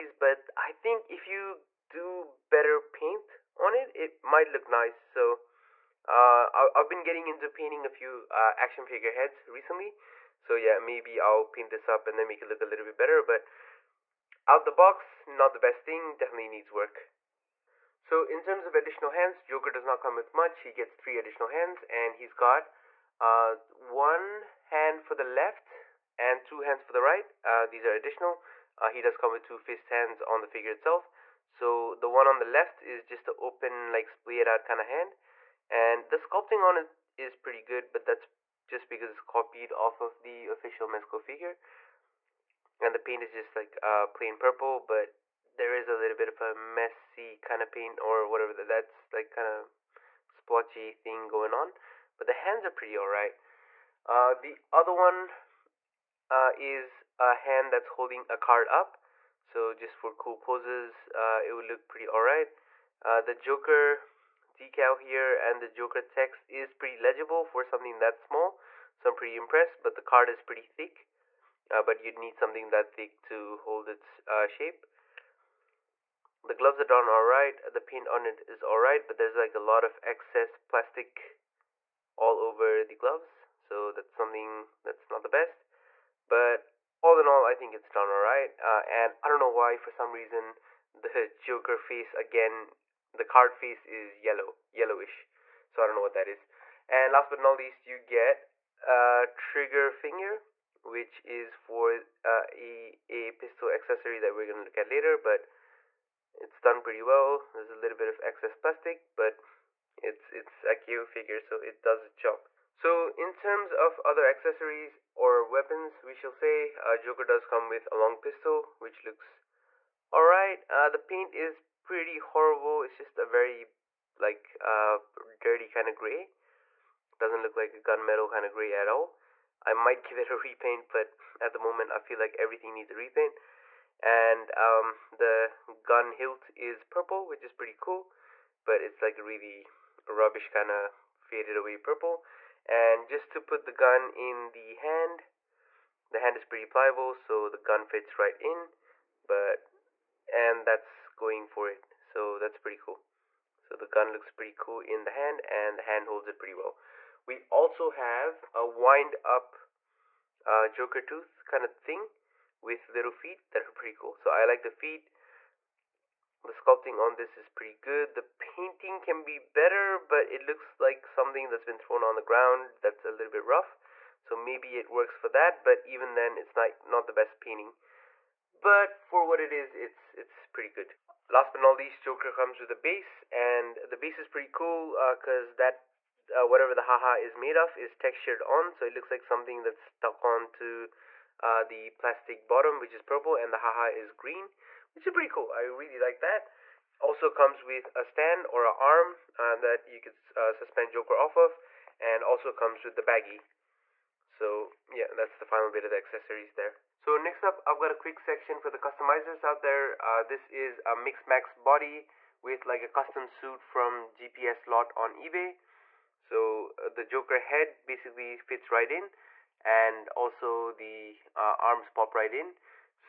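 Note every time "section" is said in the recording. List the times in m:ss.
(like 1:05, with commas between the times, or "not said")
3:28.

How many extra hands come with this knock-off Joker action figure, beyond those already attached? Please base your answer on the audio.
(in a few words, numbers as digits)
3.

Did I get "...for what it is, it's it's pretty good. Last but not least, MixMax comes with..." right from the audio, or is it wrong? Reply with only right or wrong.
wrong.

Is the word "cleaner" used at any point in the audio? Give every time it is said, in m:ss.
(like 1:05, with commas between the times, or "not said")
not said.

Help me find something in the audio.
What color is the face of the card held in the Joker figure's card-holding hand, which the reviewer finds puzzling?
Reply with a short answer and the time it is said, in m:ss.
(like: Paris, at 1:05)
Yellowish, at 1:34.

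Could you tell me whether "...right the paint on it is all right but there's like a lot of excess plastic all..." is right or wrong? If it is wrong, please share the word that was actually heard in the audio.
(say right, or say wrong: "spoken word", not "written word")
right.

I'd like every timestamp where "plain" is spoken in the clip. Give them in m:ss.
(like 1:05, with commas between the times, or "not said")
0:44.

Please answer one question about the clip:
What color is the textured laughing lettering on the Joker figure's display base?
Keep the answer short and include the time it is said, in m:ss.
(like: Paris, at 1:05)
Green, at 3:14.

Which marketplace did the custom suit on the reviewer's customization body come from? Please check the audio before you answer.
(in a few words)
eBay.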